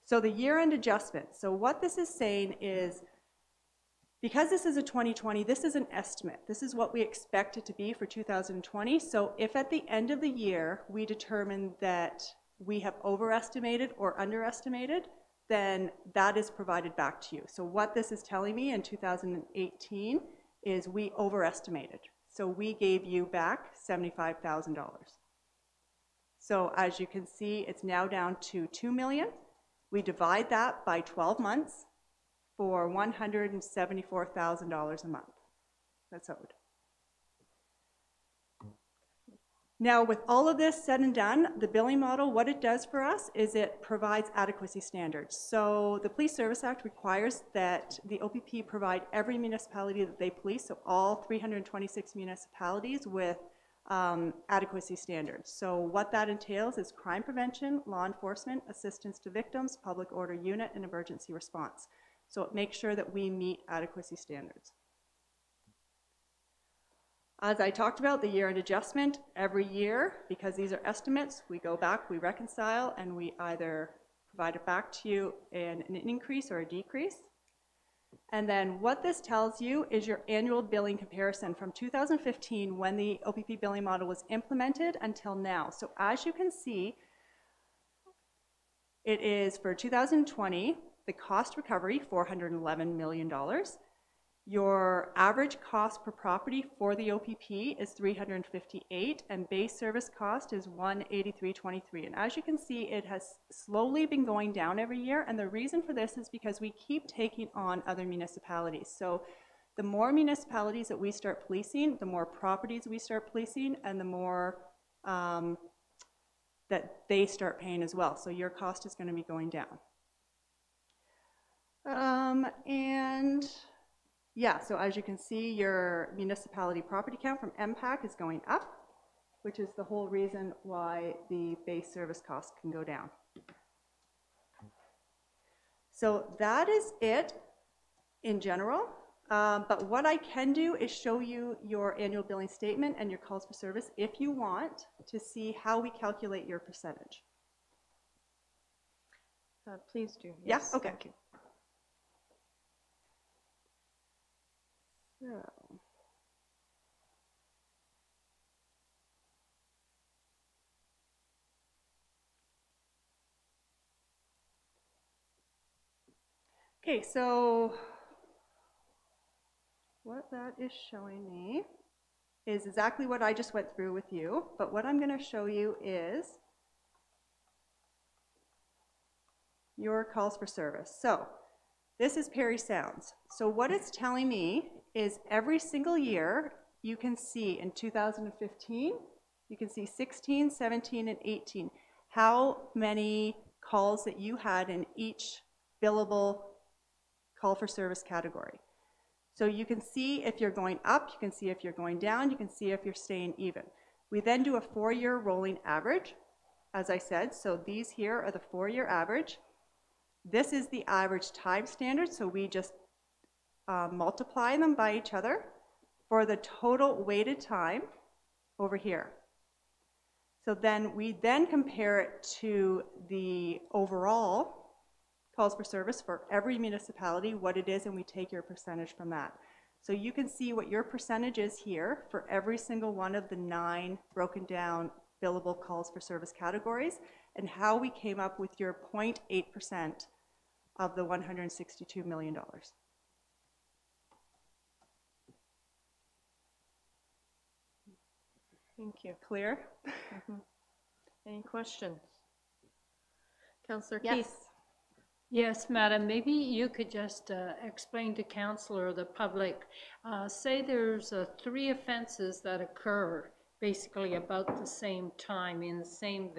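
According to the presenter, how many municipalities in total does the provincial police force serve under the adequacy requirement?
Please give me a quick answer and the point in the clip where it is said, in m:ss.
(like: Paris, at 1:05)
326, at 0:51.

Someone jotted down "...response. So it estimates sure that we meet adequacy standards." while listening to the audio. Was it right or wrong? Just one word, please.
wrong.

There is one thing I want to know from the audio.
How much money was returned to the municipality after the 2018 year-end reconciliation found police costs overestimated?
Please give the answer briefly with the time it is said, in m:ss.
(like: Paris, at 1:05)
$75,000, at 0:23.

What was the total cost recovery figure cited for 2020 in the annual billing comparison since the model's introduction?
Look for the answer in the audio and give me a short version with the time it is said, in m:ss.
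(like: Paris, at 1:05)
$411 million, at 1:32.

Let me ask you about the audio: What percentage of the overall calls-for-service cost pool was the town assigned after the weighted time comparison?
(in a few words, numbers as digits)
0.8%.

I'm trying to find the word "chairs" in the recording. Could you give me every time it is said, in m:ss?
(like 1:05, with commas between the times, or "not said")
not said.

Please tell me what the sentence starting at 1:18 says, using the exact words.
And then what this tells you is your annual billing comparison from 2015 when the OPP billing model was implemented until now.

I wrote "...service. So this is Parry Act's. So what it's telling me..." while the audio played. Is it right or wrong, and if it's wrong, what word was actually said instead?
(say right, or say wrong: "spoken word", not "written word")
wrong: "Sound", not "Act".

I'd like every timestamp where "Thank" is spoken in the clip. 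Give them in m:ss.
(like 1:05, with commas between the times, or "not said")
2:30, 4:08.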